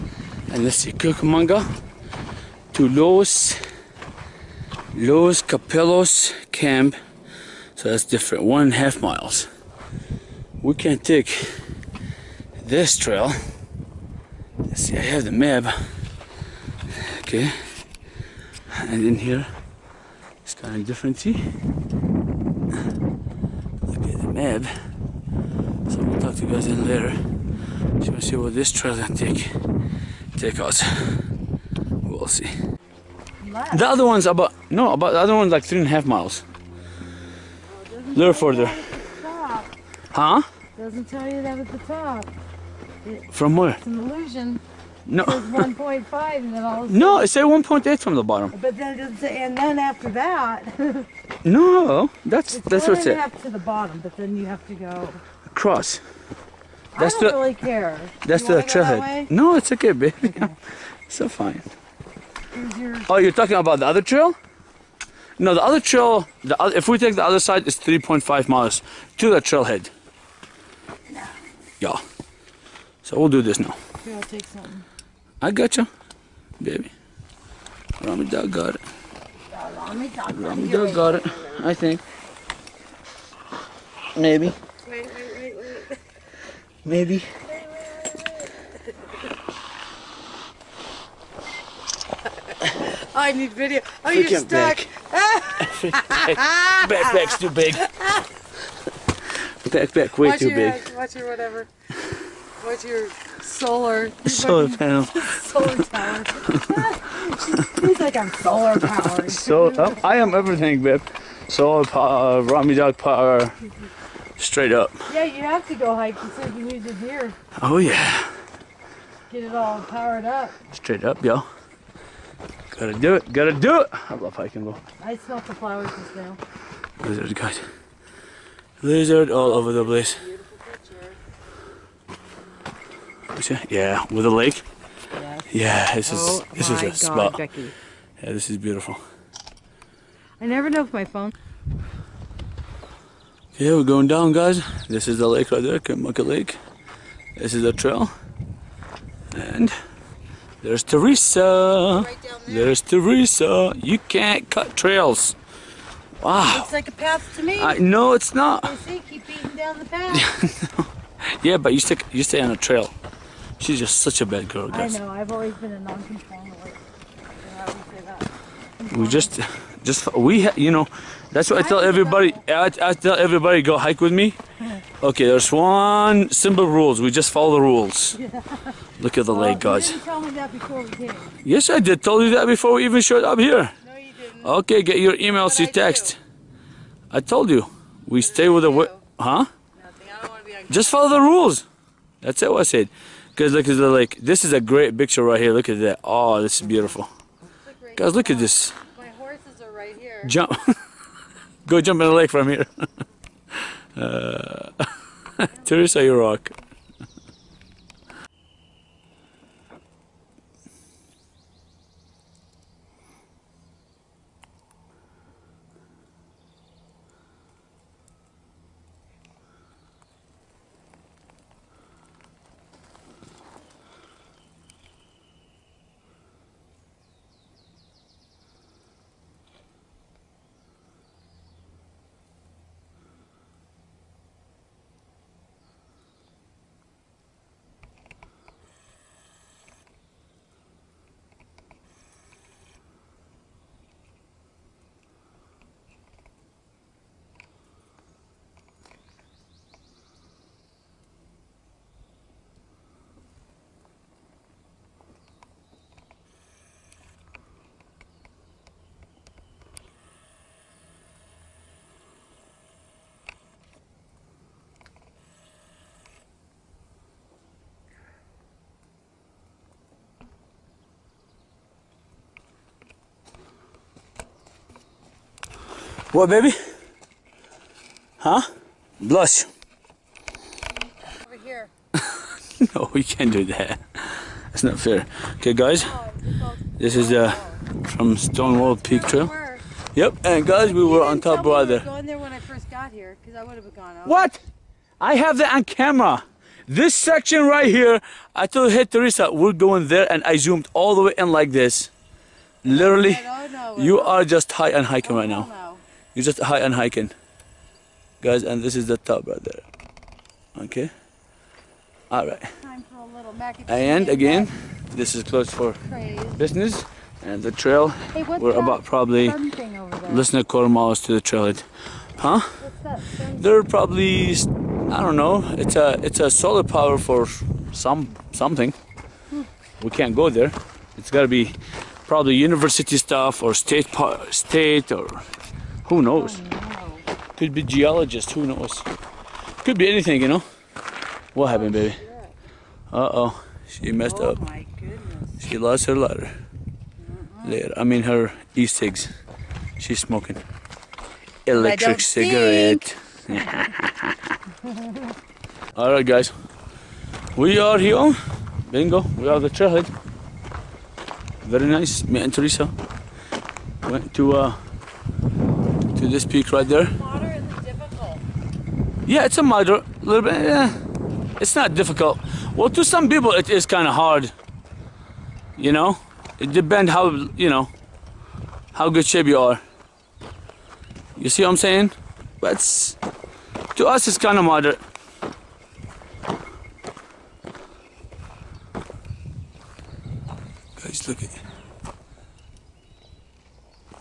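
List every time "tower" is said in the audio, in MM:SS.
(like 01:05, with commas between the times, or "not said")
01:45.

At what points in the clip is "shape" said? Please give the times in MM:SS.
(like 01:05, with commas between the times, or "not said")
06:19.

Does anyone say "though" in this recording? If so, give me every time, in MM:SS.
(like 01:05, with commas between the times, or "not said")
02:04.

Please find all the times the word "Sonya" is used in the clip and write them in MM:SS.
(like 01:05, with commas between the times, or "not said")
not said.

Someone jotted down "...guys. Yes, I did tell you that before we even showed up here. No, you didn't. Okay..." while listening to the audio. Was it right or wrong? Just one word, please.
right.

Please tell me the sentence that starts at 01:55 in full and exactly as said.
Yeah, you have to go hike.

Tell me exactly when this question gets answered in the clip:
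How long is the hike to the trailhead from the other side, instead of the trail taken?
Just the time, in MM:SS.
01:07.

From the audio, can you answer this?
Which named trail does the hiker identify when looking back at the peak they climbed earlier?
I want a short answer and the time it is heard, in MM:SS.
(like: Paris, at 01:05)
Stonewall Peak Trail, at 04:48.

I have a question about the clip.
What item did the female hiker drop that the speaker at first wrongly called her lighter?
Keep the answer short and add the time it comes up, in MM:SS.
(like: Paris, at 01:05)
Her e-cigs, at 05:48.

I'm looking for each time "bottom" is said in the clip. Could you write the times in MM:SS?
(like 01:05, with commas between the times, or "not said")
00:48, 00:53.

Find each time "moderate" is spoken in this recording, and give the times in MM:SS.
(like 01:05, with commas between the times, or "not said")
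06:09, 06:24.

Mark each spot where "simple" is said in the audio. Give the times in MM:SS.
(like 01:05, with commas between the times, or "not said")
02:56.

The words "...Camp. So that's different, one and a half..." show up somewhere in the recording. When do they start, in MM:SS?
00:06.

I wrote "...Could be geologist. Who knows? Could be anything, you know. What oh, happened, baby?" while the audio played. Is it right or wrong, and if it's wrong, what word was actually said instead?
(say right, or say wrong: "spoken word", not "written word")
right.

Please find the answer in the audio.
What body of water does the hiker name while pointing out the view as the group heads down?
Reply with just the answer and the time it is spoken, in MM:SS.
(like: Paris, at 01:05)
Cuyamaca Lake, at 02:25.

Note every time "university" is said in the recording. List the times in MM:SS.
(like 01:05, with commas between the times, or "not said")
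05:32.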